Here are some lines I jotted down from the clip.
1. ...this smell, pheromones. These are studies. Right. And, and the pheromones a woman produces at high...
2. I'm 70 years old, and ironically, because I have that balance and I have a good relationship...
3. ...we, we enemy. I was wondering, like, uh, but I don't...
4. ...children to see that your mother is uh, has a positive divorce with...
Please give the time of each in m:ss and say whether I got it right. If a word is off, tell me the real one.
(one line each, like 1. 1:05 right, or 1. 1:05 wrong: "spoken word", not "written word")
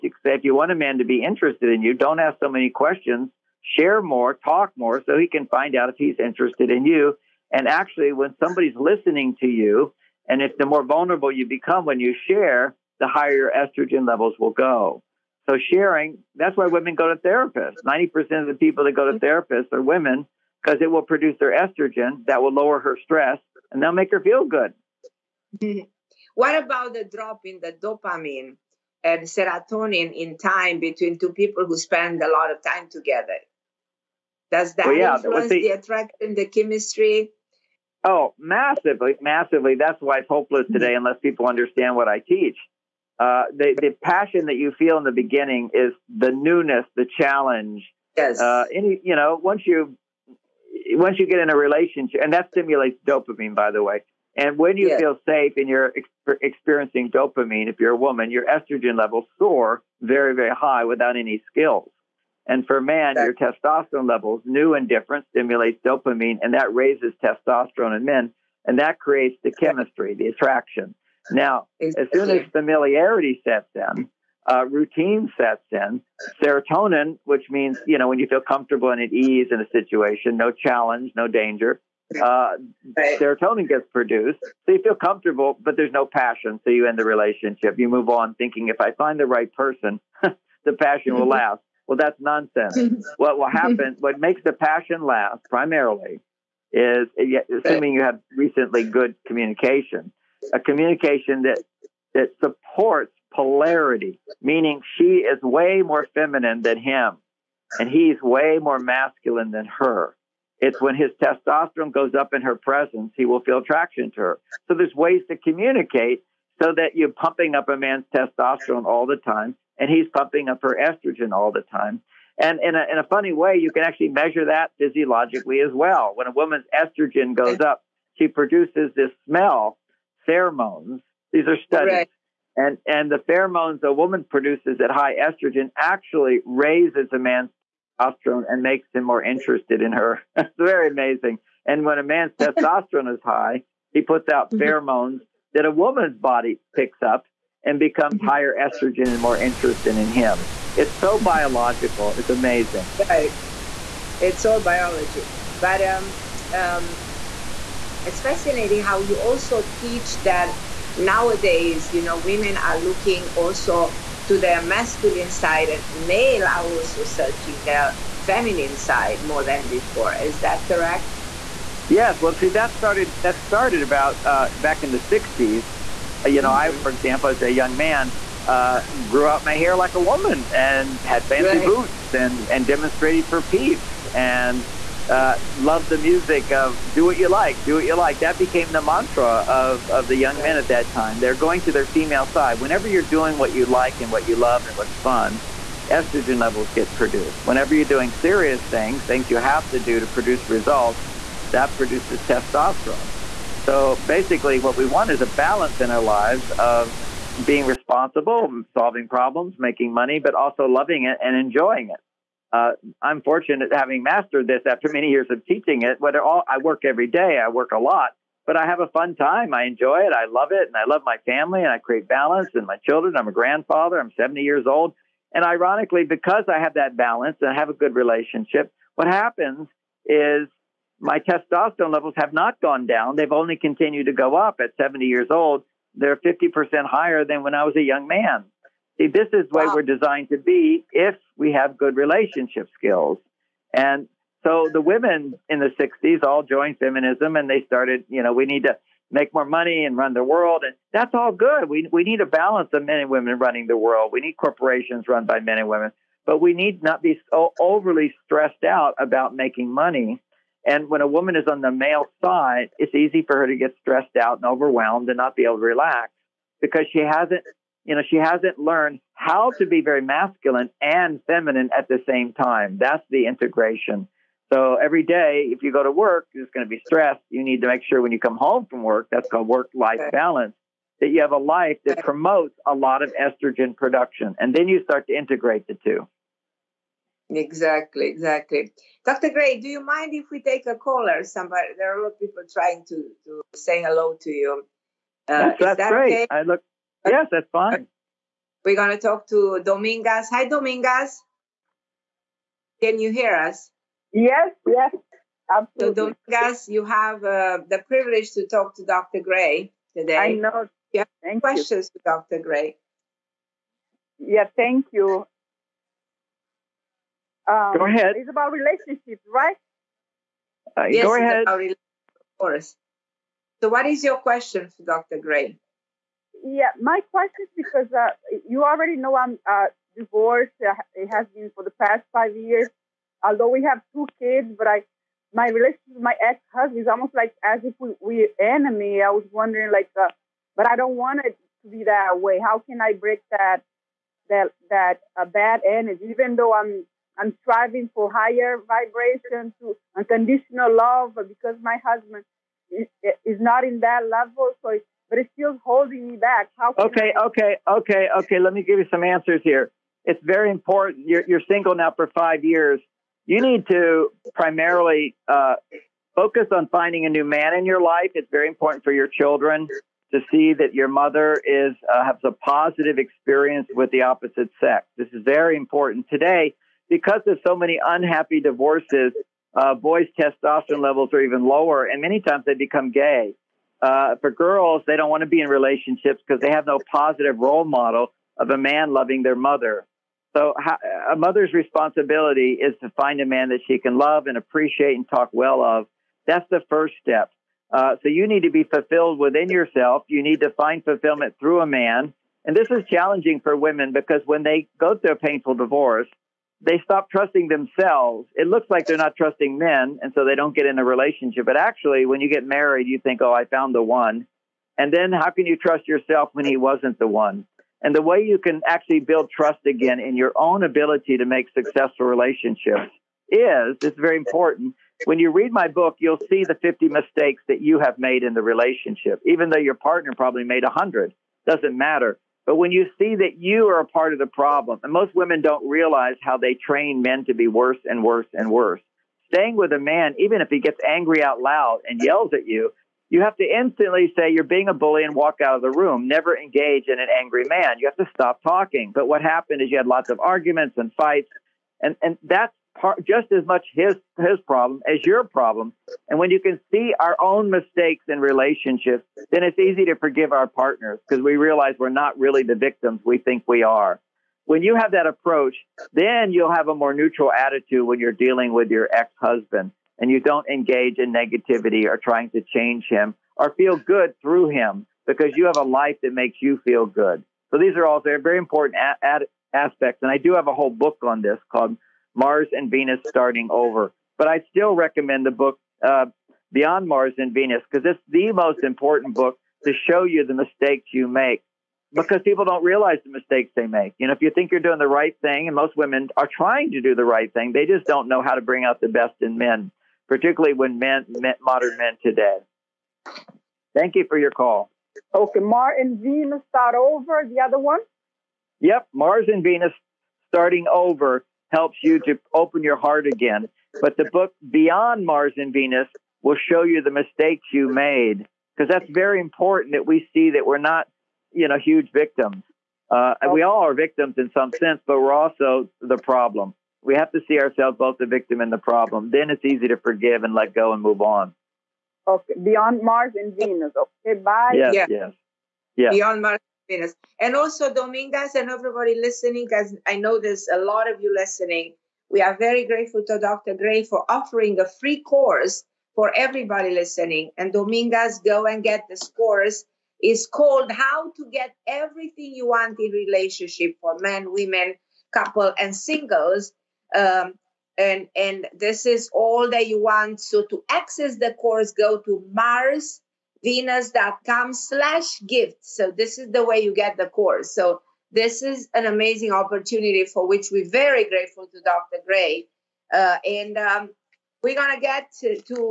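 1. 2:08 right
2. 3:43 right
3. 5:37 right
4. 6:09 wrong: "experience", not "divorce".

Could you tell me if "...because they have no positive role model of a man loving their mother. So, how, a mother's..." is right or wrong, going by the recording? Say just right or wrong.
right.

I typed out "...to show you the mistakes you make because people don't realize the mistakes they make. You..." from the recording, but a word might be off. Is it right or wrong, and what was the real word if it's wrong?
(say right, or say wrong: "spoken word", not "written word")
right.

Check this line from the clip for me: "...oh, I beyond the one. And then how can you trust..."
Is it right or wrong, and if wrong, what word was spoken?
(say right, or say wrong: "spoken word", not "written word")
wrong: "found", not "beyond".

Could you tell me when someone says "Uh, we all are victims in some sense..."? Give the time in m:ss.
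8:42.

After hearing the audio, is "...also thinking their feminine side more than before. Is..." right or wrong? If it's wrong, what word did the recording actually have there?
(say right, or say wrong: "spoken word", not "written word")
wrong: "searching", not "thinking".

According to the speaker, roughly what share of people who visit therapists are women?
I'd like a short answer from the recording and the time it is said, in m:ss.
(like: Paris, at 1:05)
90%, at 0:17.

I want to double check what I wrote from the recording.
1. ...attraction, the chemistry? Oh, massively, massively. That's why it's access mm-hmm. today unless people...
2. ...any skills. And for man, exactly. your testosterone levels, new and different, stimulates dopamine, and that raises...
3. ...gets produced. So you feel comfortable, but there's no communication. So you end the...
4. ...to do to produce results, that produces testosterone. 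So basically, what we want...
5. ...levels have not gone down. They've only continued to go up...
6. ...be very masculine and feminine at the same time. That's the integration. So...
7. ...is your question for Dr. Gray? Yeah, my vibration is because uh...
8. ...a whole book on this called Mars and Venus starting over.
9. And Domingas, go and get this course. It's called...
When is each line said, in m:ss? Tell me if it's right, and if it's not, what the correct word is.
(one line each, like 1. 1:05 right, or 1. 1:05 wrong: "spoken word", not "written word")
1. 0:35 wrong: "hopeless", not "access"
2. 1:01 right
3. 1:23 wrong: "passion", not "communication"
4. 3:19 right
5. 3:51 right
6. 4:29 right
7. 5:23 wrong: "question", not "vibration"
8. 8:00 right
9. 9:07 right.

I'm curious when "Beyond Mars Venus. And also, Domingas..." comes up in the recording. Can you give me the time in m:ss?
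8:55.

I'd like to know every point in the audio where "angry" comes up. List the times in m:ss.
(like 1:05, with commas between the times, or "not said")
7:20, 7:27.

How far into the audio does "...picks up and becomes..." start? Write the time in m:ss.
2:26.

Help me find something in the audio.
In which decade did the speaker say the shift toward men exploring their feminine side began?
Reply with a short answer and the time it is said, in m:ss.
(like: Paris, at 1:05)
1960s, at 2:55.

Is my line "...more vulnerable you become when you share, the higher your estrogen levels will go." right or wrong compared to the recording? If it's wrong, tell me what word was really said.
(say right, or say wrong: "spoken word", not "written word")
right.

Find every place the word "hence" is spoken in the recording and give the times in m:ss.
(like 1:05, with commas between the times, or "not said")
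not said.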